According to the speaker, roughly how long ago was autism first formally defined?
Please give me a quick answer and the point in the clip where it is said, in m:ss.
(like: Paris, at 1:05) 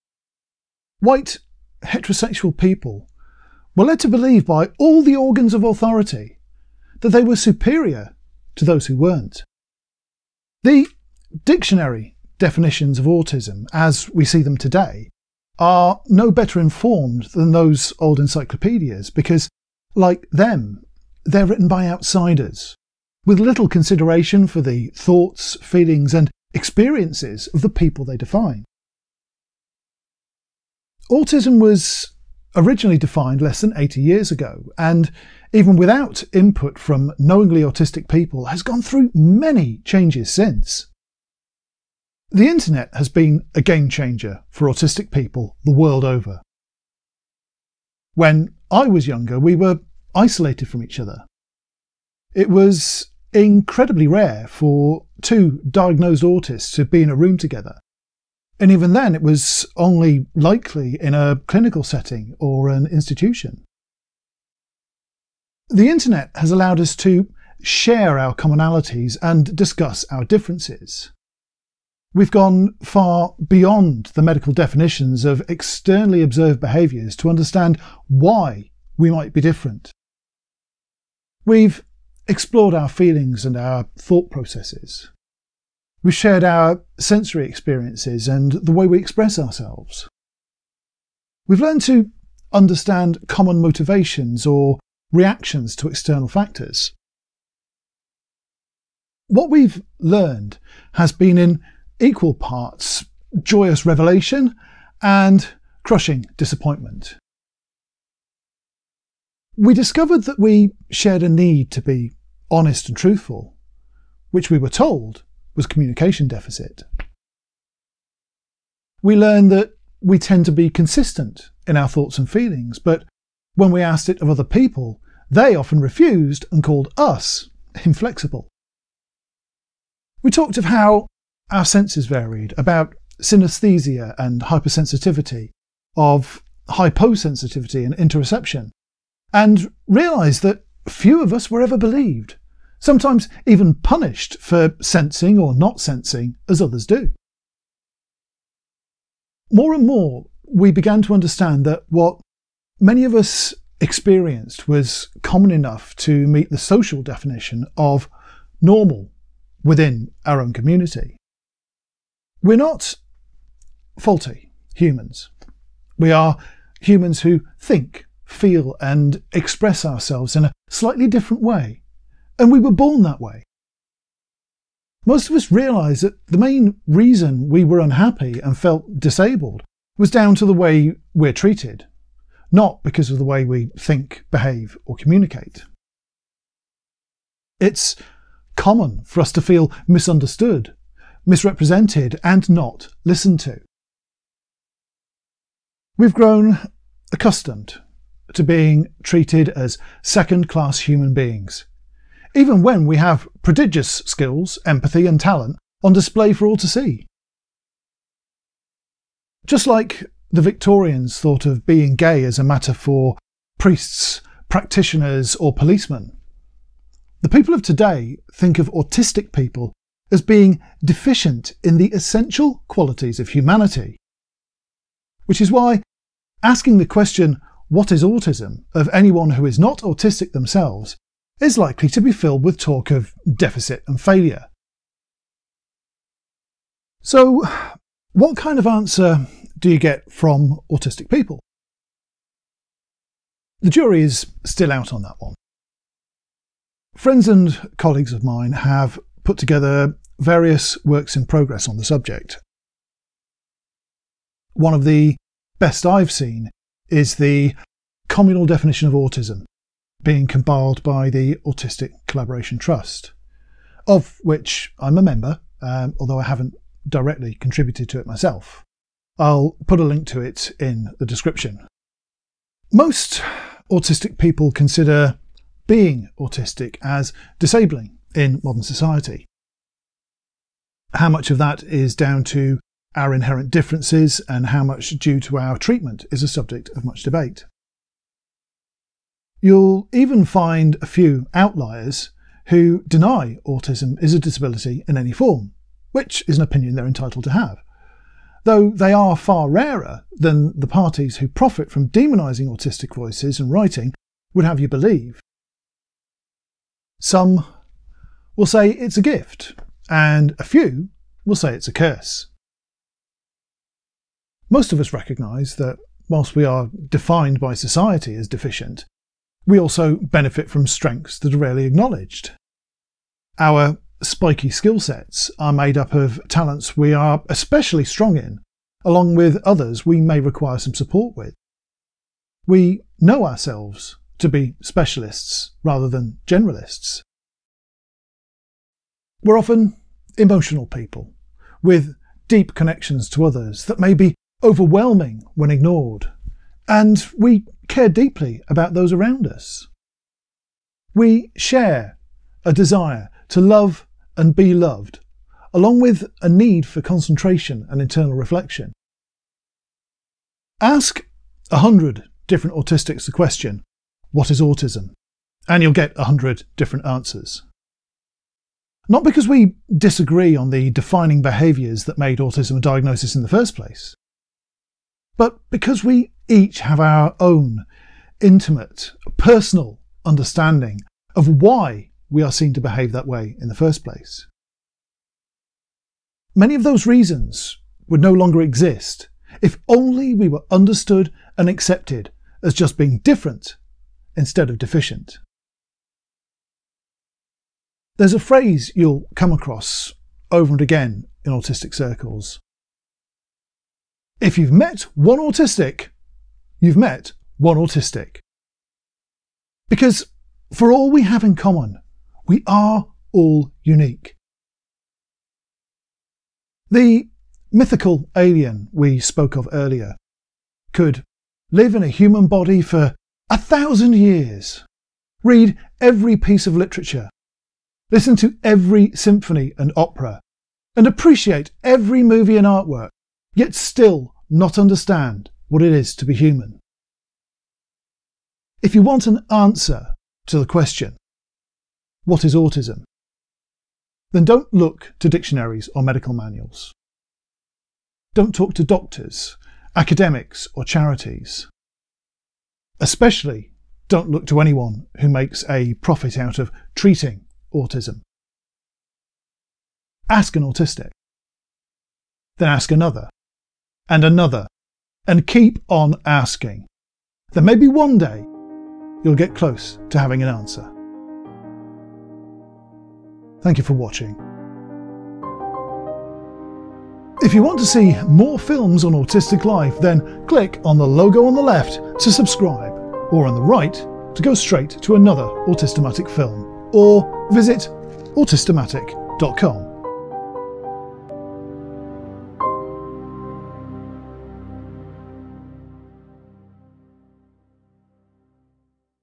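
less than 80 years ago, at 0:33.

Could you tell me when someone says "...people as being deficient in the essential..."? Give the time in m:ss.
3:39.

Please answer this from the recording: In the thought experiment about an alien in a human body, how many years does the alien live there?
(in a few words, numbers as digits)
1000.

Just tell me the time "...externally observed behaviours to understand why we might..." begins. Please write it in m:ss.
1:15.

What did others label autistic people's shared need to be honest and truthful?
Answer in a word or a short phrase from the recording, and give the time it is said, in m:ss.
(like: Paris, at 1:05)
communication deficit, at 1:55.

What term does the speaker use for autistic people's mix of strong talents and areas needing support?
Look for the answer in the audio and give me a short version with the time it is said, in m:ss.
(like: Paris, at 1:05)
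spiky skill sets, at 5:24.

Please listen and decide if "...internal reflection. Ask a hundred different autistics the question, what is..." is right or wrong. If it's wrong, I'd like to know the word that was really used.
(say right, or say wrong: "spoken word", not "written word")
right.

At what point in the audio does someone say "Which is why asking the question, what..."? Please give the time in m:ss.
3:45.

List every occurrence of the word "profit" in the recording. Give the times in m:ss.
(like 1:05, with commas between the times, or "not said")
5:01, 7:35.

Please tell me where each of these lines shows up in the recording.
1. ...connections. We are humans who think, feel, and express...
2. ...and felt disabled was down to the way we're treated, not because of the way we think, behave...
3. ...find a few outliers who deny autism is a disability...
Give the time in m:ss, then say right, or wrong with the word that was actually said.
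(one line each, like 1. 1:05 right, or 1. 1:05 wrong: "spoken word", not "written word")
1. 2:44 wrong: "humans", not "connections"
2. 2:58 right
3. 4:50 right.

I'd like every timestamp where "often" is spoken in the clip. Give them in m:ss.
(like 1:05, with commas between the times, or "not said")
2:05, 5:39.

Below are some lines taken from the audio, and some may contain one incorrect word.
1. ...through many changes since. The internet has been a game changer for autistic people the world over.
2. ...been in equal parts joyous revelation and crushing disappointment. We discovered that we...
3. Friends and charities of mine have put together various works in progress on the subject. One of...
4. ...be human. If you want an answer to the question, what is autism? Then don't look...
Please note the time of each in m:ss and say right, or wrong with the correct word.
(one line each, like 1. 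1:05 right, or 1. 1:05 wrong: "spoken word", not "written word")
1. 0:38 right
2. 1:41 right
3. 4:06 wrong: "colleagues", not "charities"
4. 7:16 right.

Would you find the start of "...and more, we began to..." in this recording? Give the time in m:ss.
2:29.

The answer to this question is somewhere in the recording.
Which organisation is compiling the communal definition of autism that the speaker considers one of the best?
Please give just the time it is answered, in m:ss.
4:21.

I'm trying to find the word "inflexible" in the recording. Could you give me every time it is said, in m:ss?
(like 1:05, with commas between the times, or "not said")
2:07.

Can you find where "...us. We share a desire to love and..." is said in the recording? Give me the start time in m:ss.
5:49.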